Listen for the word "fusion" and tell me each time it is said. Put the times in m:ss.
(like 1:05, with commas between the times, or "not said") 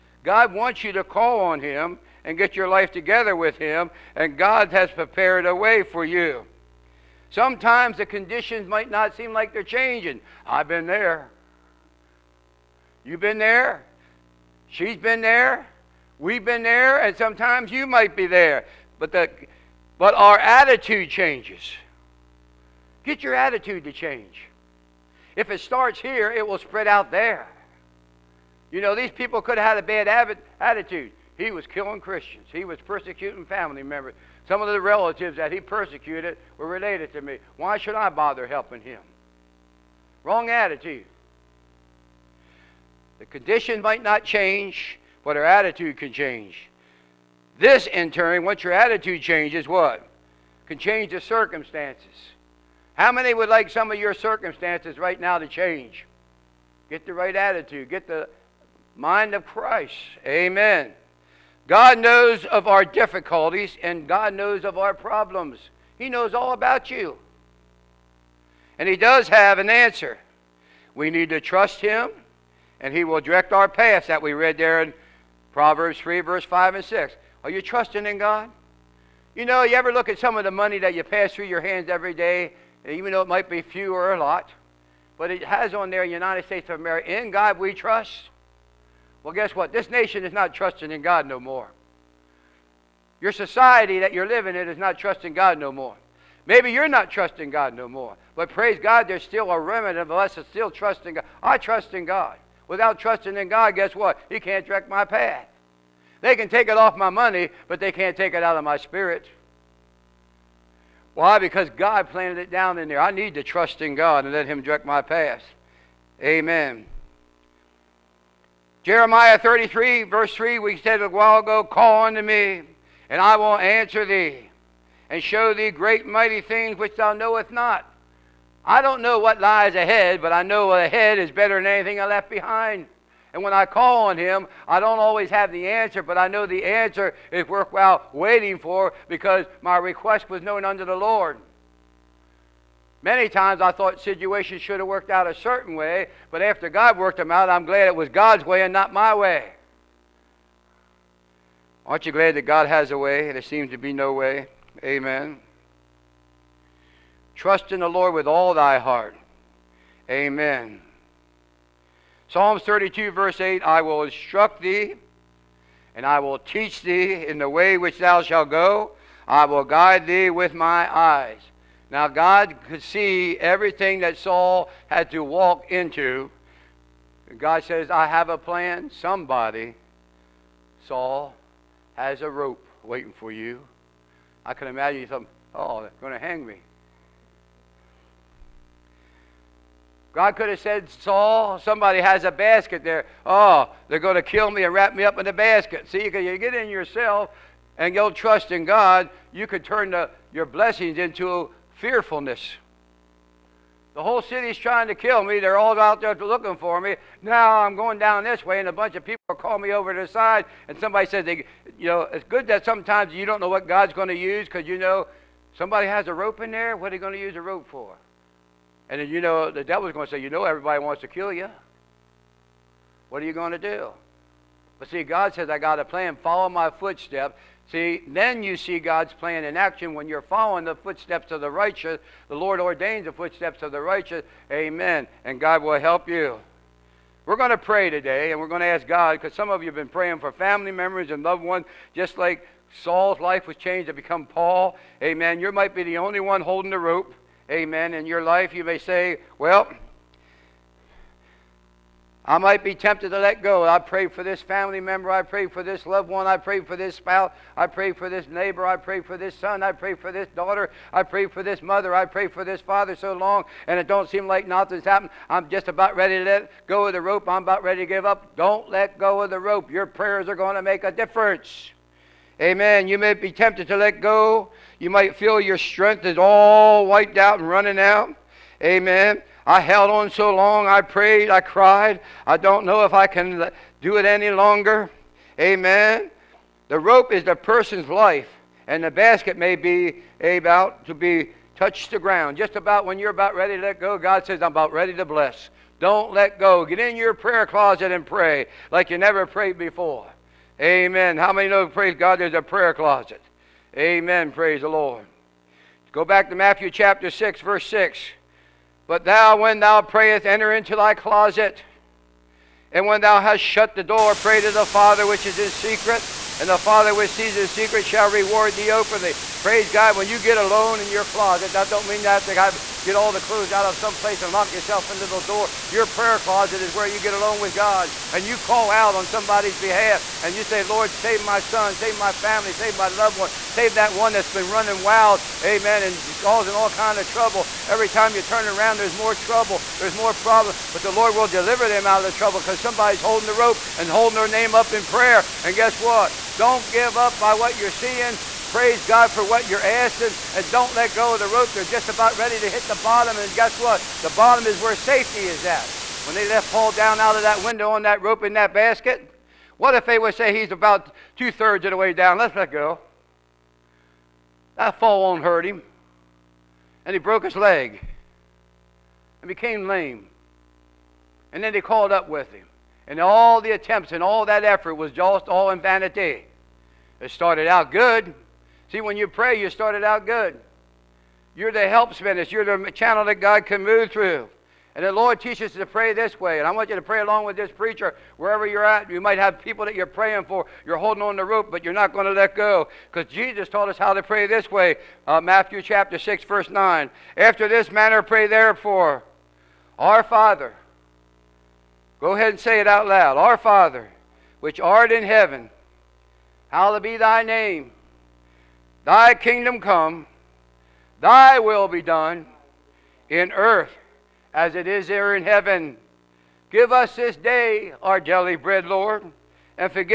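not said.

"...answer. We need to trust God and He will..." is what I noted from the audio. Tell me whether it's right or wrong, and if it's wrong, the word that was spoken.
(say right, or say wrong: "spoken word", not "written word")
wrong: "Him", not "God".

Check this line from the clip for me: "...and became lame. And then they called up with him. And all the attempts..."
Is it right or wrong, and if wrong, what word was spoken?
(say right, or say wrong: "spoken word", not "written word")
right.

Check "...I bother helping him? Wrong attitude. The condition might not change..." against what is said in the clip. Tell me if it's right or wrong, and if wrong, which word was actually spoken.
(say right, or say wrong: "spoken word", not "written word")
right.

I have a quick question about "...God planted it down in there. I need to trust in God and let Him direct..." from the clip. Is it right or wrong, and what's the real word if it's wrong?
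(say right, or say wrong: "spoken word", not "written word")
right.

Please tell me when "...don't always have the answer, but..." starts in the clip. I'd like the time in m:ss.
2:14.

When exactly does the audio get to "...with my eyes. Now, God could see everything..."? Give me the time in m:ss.
2:50.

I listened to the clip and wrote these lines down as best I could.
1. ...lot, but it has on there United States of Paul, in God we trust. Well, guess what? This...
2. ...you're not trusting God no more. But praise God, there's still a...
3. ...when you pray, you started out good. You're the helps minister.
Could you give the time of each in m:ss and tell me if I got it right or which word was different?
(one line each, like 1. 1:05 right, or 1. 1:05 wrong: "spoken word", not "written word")
1. 1:24 wrong: "America", not "Paul"
2. 1:36 right
3. 6:18 right.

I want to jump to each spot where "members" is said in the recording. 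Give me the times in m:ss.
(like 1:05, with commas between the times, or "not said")
0:33, 4:00, 4:14.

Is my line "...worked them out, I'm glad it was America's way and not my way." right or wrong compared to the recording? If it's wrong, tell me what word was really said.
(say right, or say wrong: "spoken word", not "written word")
wrong: "God", not "America".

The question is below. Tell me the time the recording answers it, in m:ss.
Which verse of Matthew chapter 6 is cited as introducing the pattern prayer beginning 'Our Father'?
6:36.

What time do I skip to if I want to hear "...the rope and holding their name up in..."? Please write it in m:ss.
5:43.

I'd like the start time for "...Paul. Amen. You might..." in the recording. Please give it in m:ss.
4:04.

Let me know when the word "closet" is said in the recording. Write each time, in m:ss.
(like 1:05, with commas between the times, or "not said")
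4:57, 5:02, 5:10, 5:21, 5:26.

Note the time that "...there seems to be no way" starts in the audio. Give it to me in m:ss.
2:33.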